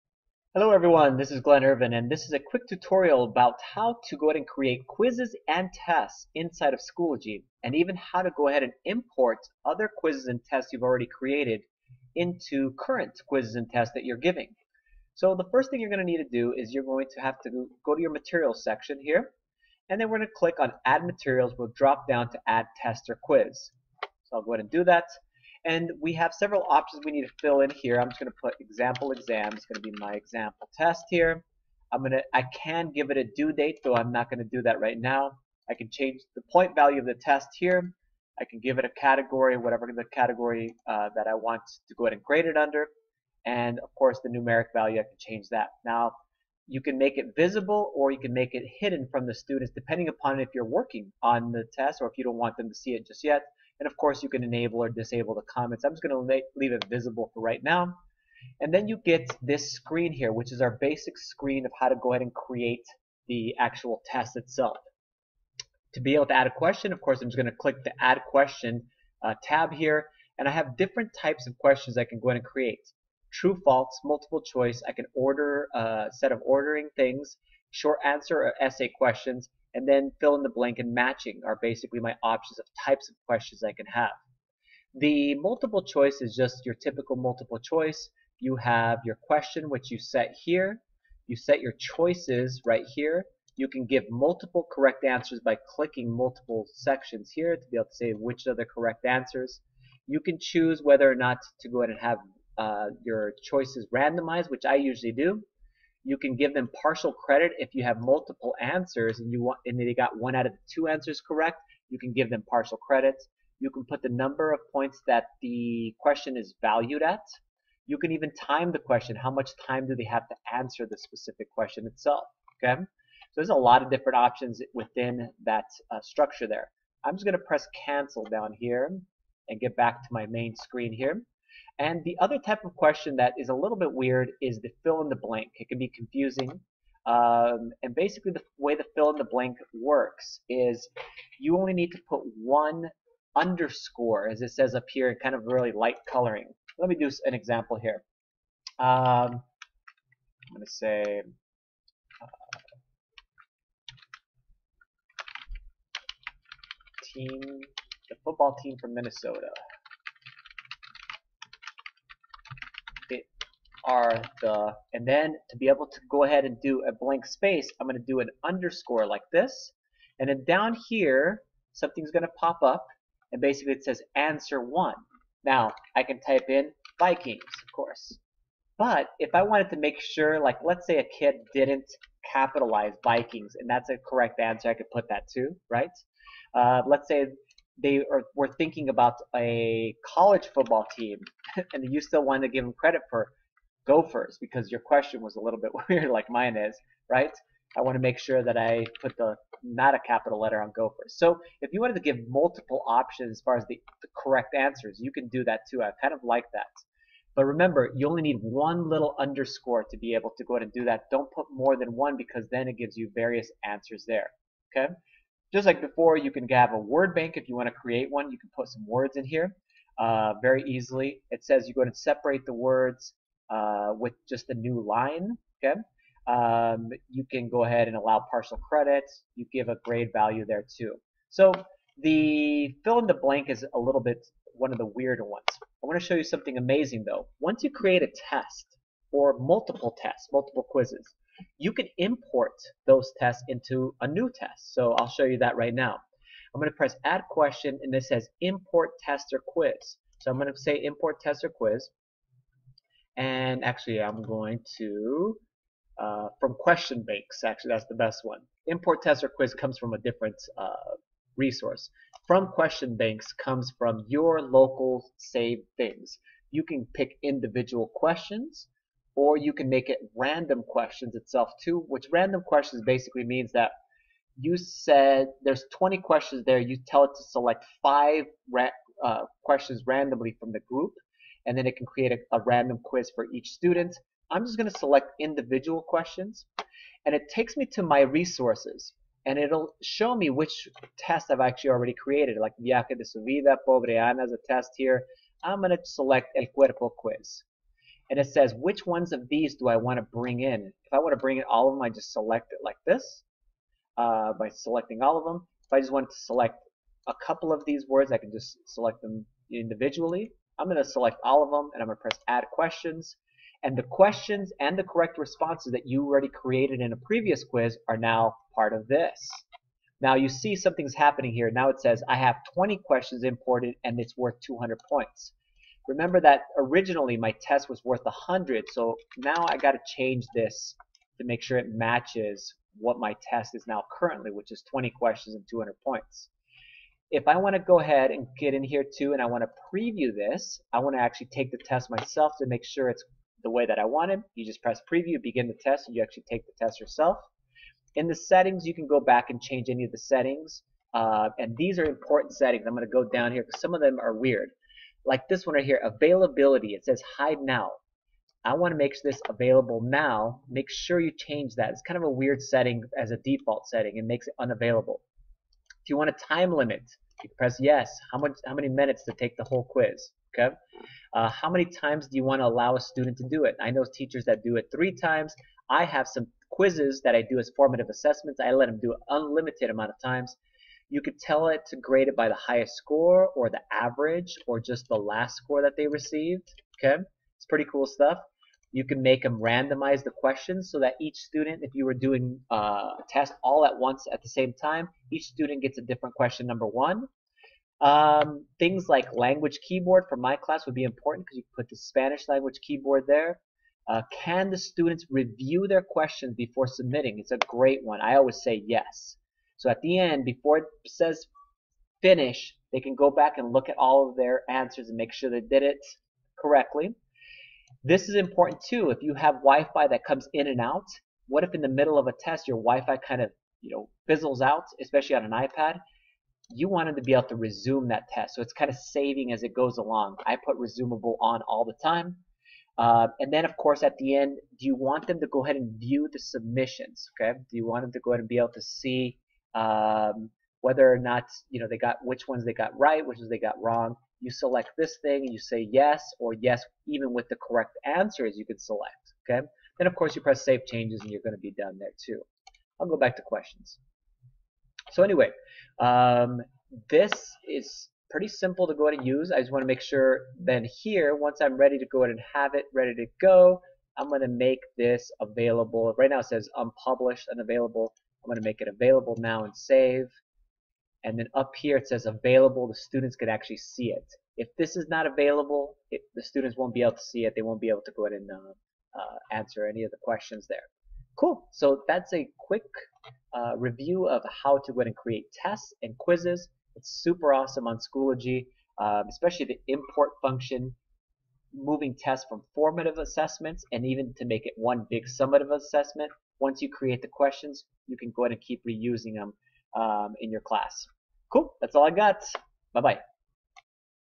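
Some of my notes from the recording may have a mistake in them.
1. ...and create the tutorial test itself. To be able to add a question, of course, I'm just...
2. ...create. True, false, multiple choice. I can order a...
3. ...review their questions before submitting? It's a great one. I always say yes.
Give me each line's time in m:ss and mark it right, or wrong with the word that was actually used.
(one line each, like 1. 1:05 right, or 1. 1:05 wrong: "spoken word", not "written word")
1. 1:02 wrong: "actual", not "tutorial"
2. 1:12 right
3. 6:45 right.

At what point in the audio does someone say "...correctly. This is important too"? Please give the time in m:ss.
6:56.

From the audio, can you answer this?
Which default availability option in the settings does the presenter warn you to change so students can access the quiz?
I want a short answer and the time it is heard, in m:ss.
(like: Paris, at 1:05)
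hide now, at 5:57.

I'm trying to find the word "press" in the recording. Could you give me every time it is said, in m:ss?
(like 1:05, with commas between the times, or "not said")
2:07, 4:06, 5:12, 5:44, 6:07, 7:30.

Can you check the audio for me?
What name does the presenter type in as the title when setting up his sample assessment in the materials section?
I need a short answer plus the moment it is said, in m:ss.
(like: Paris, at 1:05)
example exam, at 0:28.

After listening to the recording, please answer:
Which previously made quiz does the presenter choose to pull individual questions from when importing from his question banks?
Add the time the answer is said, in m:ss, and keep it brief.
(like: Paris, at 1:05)
El Cuerpo quiz, at 4:56.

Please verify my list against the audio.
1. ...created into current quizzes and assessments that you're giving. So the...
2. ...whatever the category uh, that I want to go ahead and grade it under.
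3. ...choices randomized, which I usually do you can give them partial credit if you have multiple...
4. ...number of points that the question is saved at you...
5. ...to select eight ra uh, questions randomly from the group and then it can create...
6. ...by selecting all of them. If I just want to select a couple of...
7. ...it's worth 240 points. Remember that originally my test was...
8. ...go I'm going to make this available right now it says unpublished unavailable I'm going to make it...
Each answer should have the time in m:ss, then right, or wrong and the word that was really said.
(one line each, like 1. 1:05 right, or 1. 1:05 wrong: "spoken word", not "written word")
1. 0:11 wrong: "tests", not "assessments"
2. 0:39 right
3. 1:43 right
4. 1:54 wrong: "valued", not "saved"
5. 4:37 wrong: "five", not "eight"
6. 5:04 right
7. 5:23 wrong: "200", not "240"
8. 7:43 right.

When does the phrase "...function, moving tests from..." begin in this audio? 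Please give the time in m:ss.
8:10.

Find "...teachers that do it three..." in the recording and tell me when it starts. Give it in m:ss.
6:13.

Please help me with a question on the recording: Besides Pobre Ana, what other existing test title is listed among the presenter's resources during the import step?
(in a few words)
Viaje de su vida.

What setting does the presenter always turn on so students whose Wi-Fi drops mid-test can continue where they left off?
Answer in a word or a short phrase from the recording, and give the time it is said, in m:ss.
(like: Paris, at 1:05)
resumable, at 7:10.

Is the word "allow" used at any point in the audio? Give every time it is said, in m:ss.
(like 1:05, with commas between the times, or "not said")
3:47, 6:12.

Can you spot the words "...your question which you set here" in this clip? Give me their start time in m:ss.
1:29.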